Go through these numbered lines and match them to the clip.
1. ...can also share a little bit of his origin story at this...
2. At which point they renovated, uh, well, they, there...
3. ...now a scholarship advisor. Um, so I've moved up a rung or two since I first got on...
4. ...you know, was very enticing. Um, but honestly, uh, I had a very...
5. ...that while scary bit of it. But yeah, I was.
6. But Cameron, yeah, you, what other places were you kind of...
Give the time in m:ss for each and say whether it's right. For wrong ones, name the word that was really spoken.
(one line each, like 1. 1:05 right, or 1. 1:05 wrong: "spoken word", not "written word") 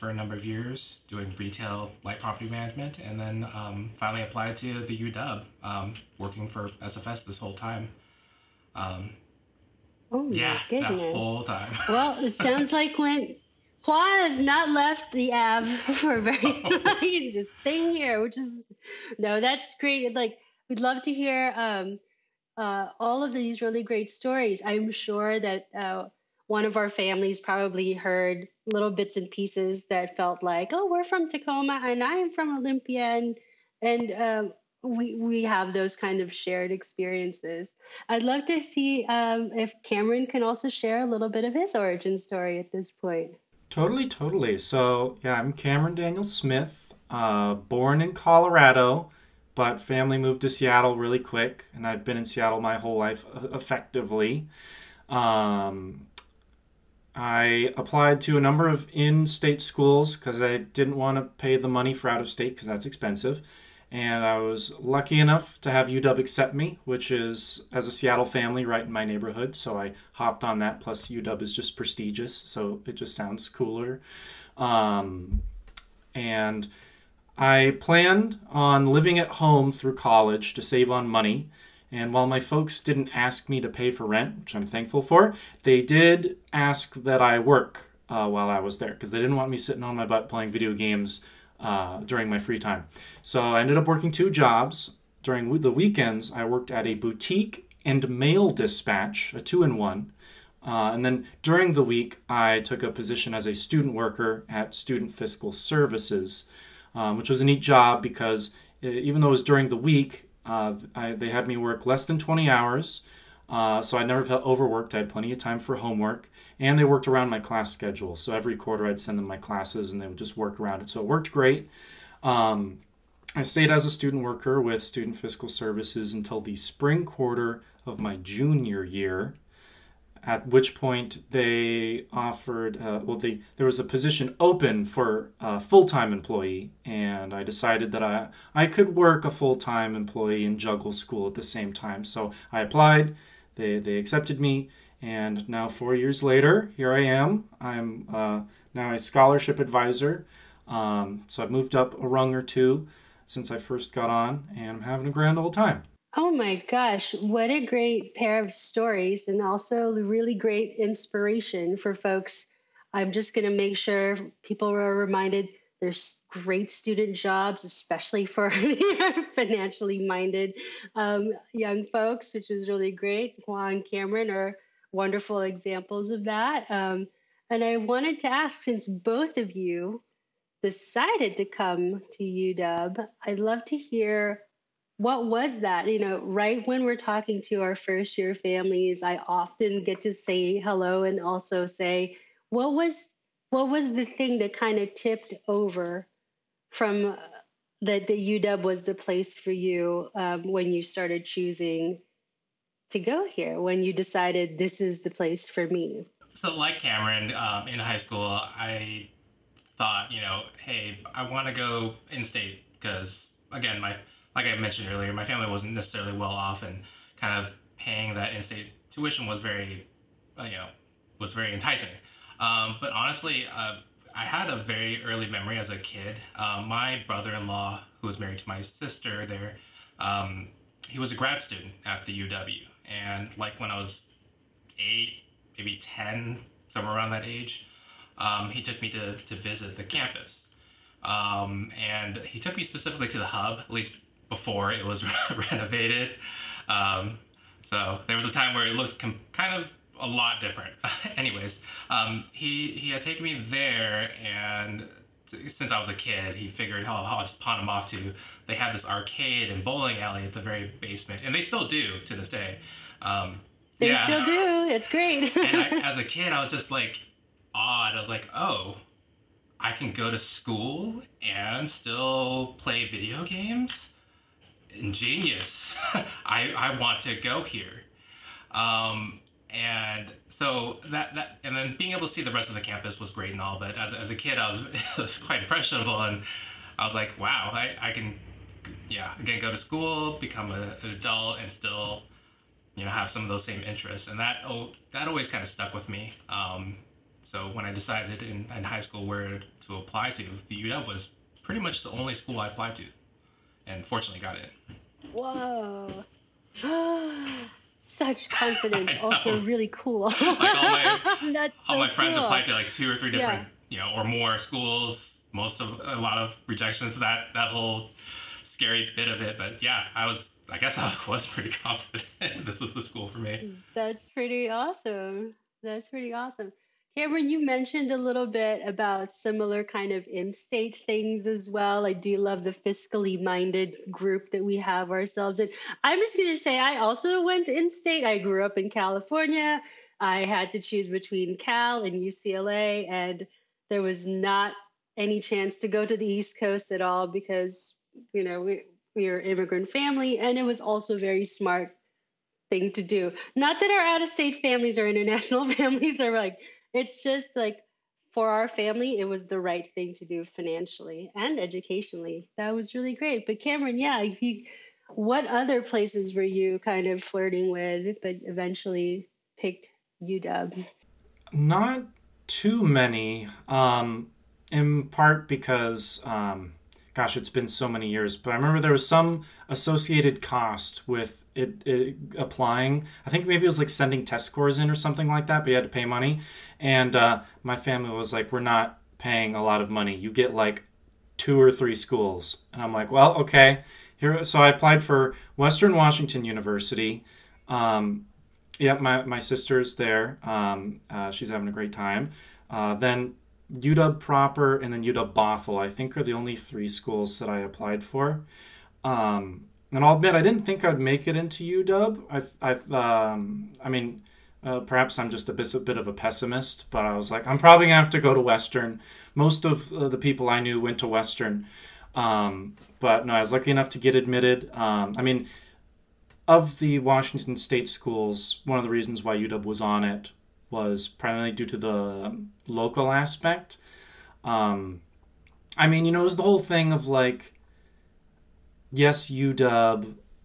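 1. 0:40 right
2. 2:10 wrong: "offered", not "renovated"
3. 2:28 right
4. 3:40 right
5. 5:17 wrong: "whole", not "while"
6. 6:03 right.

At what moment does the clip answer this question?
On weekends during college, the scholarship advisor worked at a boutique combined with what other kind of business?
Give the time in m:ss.
1:38.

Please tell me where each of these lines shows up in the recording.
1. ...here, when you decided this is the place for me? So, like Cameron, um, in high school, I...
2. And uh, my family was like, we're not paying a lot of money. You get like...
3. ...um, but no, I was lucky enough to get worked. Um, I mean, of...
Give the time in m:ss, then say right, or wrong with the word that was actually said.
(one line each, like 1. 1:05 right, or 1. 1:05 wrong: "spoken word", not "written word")
1. 3:23 right
2. 6:26 right
3. 7:01 wrong: "admitted", not "worked".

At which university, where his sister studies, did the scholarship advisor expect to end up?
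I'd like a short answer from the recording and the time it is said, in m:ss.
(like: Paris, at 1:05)
Western Washington University, at 6:35.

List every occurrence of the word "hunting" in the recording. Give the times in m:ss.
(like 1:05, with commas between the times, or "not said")
not said.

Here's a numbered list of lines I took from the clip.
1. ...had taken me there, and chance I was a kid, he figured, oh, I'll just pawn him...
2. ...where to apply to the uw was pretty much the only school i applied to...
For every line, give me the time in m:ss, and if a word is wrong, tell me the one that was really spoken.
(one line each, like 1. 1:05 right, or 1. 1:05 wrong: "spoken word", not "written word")
1. 4:12 wrong: "since", not "chance"
2. 4:59 right.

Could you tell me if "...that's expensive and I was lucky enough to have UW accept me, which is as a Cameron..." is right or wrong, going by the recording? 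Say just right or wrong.
wrong.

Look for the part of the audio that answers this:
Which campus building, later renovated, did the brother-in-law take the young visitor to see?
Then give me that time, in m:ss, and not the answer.
4:03.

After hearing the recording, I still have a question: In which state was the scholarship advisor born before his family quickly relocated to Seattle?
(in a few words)
Colorado.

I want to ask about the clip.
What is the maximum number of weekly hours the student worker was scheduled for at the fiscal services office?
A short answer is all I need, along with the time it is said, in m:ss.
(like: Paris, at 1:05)
20, at 1:52.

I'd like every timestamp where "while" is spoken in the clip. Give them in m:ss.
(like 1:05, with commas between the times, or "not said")
1:22, 1:28.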